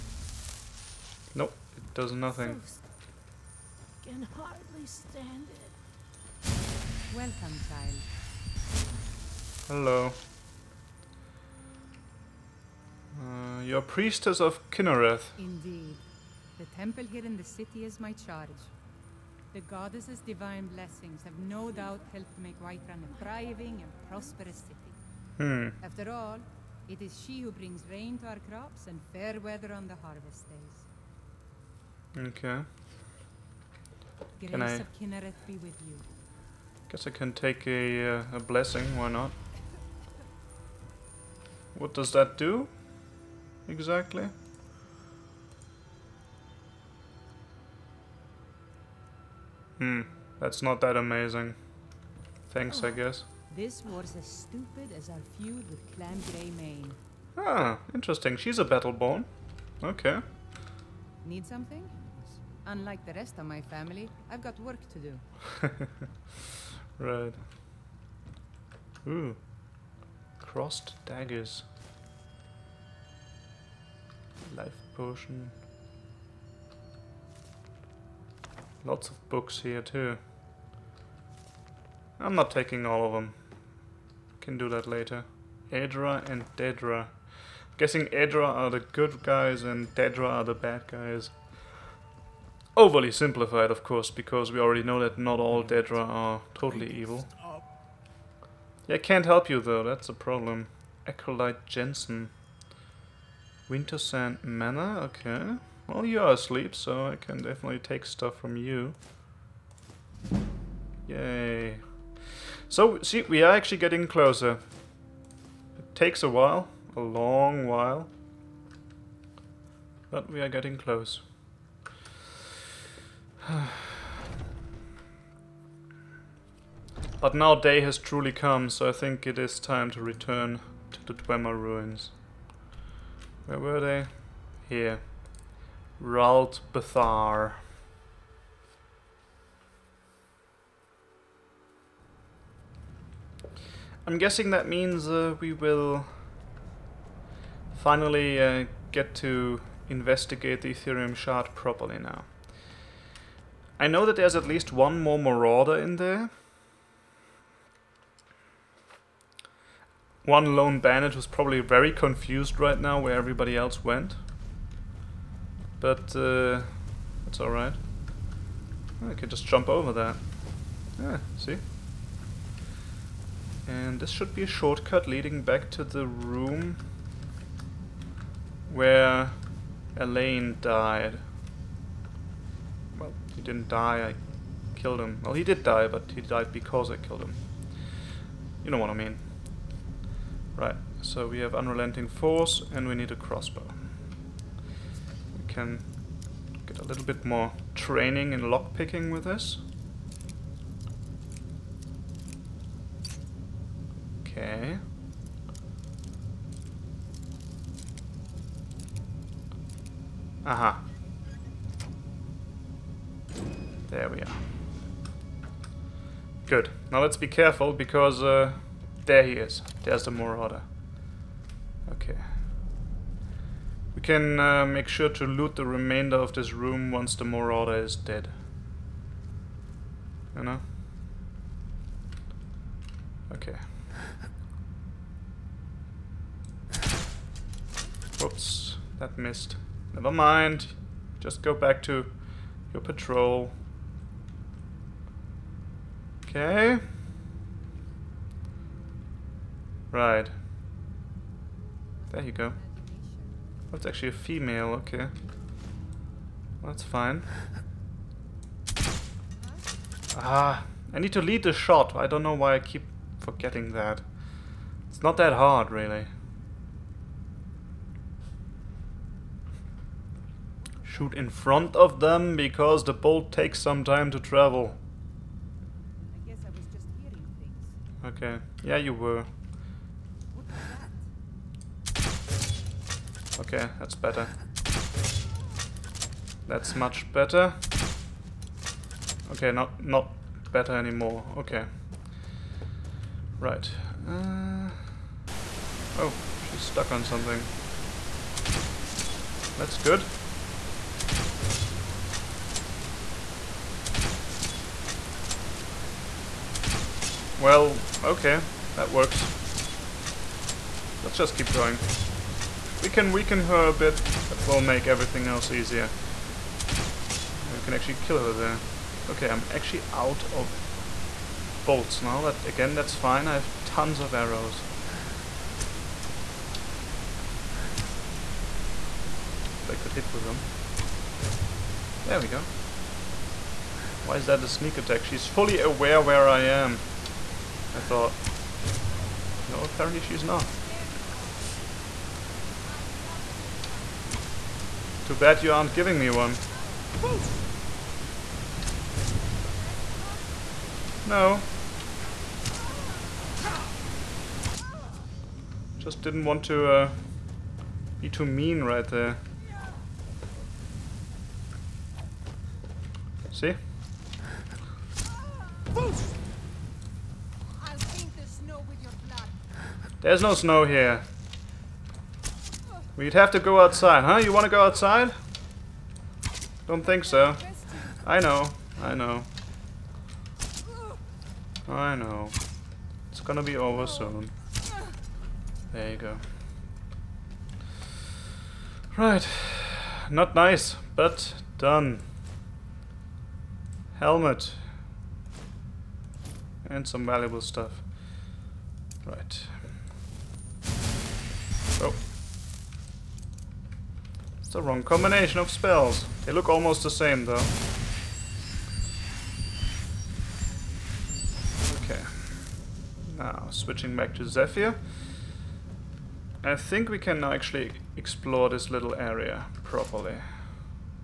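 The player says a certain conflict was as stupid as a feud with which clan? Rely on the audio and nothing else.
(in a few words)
Clan Greymane.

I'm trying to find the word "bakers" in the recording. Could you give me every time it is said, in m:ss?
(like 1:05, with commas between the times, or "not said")
not said.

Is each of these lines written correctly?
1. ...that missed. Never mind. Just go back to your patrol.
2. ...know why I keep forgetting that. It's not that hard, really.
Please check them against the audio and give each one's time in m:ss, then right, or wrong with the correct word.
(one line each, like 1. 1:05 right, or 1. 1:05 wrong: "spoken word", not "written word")
1. 3:58 right
2. 4:22 right.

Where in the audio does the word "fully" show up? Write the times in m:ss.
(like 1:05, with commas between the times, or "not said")
5:35.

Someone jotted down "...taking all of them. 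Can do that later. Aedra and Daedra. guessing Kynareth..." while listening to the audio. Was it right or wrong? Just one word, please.
wrong.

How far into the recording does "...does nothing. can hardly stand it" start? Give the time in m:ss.
0:01.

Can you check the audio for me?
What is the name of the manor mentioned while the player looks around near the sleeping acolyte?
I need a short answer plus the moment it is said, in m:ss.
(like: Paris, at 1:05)
Winter Sand Manor, at 1:43.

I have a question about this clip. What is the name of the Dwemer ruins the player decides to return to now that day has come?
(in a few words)
Ralt Bathar.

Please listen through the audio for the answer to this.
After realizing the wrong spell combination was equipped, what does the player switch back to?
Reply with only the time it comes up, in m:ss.
6:54.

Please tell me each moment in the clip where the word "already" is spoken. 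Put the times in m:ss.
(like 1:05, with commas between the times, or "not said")
1:34.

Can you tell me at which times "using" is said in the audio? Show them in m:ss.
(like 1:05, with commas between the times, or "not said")
not said.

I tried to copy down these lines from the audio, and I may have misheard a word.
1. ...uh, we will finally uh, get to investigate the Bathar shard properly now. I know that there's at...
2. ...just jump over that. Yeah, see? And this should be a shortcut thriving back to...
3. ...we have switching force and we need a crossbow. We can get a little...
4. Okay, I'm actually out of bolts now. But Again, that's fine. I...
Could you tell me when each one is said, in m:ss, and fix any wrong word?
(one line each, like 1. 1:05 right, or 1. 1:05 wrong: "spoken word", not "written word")
1. 2:25 wrong: "Aetherium", not "Bathar"
2. 2:49 wrong: "leading", not "thriving"
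3. 3:11 wrong: "unrelenting", not "switching"
4. 5:19 right.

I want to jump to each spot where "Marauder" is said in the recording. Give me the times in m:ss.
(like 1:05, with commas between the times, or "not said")
2:35, 3:40, 3:47.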